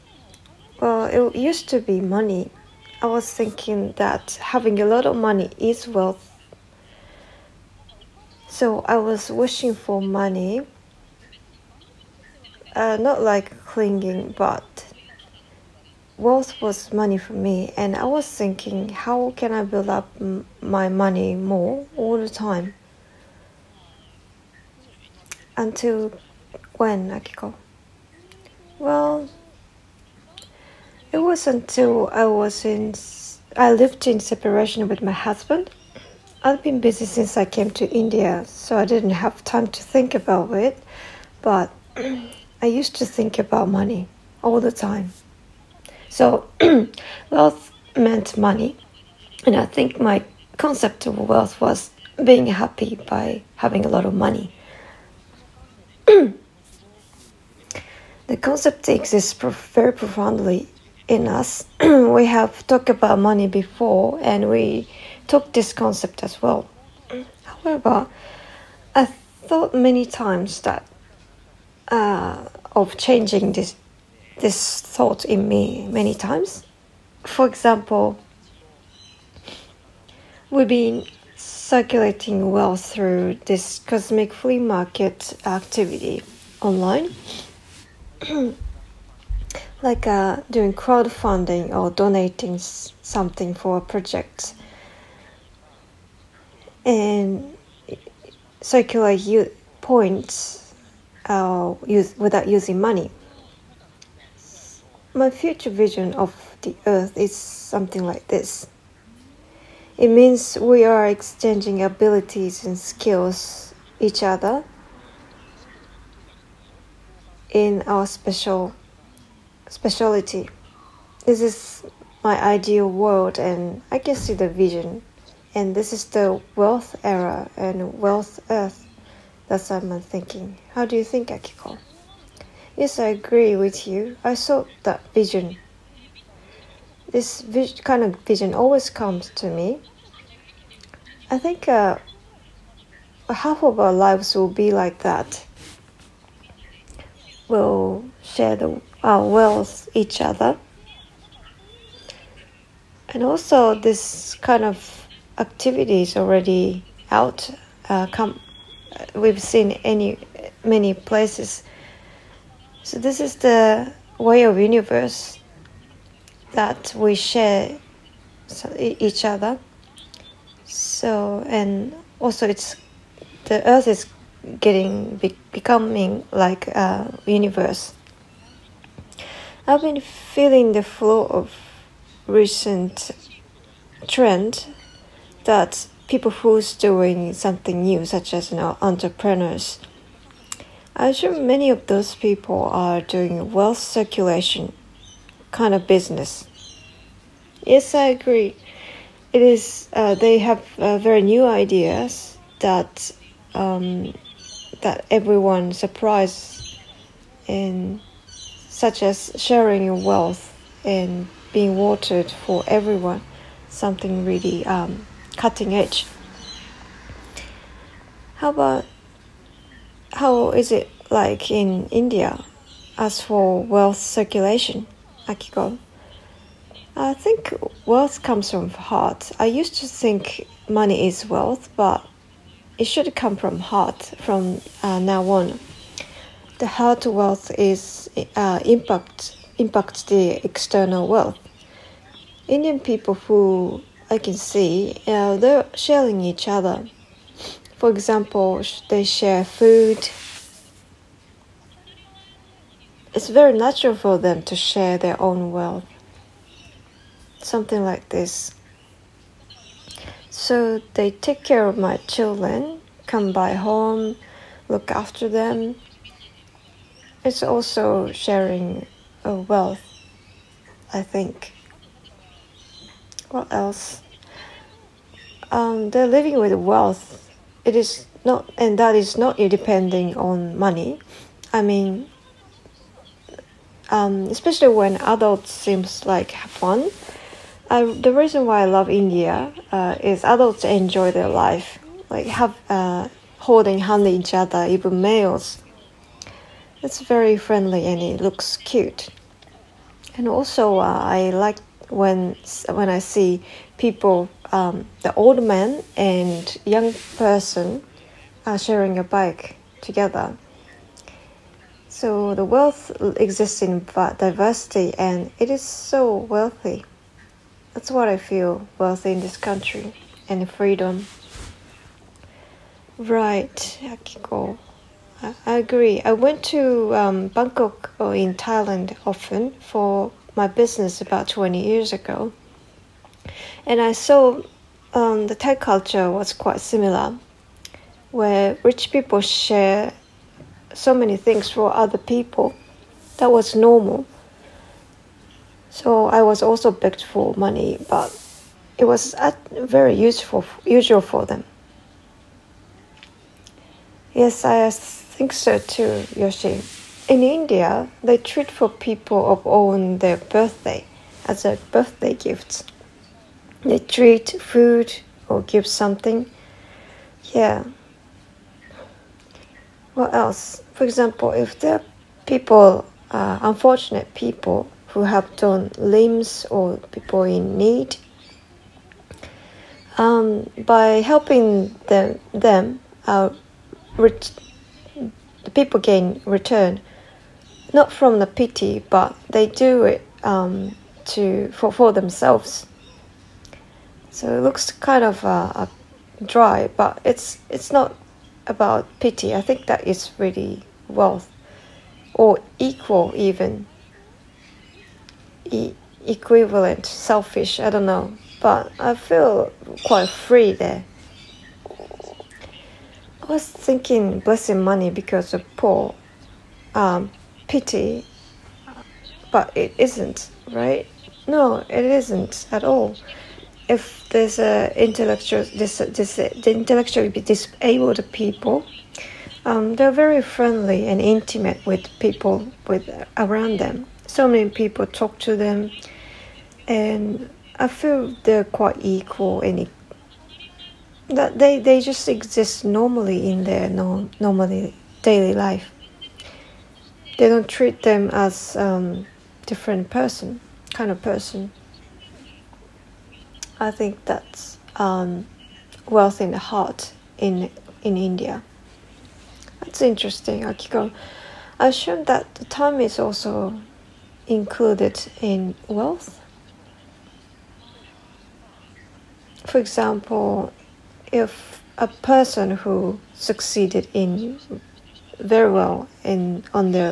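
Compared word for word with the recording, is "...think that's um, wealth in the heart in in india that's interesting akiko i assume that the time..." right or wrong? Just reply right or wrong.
right.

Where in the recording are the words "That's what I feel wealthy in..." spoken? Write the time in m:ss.
5:17.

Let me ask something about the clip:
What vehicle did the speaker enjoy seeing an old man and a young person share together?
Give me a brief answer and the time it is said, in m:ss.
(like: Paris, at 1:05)
bike, at 5:09.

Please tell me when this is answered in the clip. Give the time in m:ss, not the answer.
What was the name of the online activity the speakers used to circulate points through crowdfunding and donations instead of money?
1:23.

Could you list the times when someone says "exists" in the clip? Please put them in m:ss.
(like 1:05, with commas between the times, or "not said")
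0:58, 5:13, 7:22.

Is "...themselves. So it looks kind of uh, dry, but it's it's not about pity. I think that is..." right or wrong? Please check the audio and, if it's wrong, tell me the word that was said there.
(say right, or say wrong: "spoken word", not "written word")
right.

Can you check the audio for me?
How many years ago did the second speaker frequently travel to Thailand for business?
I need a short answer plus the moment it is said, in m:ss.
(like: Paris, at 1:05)
20, at 5:31.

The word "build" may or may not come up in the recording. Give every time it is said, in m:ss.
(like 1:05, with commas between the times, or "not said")
0:19.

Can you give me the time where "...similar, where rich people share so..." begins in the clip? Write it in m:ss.
5:36.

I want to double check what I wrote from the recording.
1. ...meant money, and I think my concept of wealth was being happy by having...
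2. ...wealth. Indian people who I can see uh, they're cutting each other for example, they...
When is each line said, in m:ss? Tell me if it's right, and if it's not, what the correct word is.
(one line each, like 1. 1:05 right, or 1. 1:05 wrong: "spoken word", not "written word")
1. 0:47 right
2. 4:01 wrong: "sharing", not "cutting".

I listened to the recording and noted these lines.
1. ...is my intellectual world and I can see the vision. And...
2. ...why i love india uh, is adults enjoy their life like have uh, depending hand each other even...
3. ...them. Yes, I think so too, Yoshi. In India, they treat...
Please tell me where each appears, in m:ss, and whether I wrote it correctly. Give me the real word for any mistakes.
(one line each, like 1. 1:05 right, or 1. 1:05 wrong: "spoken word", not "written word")
1. 2:01 wrong: "ideal", not "intellectual"
2. 4:48 wrong: "holding", not "depending"
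3. 5:51 right.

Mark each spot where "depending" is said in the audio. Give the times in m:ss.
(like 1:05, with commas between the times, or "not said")
4:39.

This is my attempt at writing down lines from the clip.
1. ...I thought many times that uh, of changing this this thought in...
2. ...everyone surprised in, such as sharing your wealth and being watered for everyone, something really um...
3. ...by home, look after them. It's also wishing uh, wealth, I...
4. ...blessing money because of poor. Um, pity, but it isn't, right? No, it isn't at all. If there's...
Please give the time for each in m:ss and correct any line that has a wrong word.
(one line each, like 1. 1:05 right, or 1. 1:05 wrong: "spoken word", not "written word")
1. 1:08 right
2. 3:25 right
3. 4:23 wrong: "sharing", not "wishing"
4. 6:54 right.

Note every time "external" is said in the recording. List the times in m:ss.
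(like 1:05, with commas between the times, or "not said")
4:00.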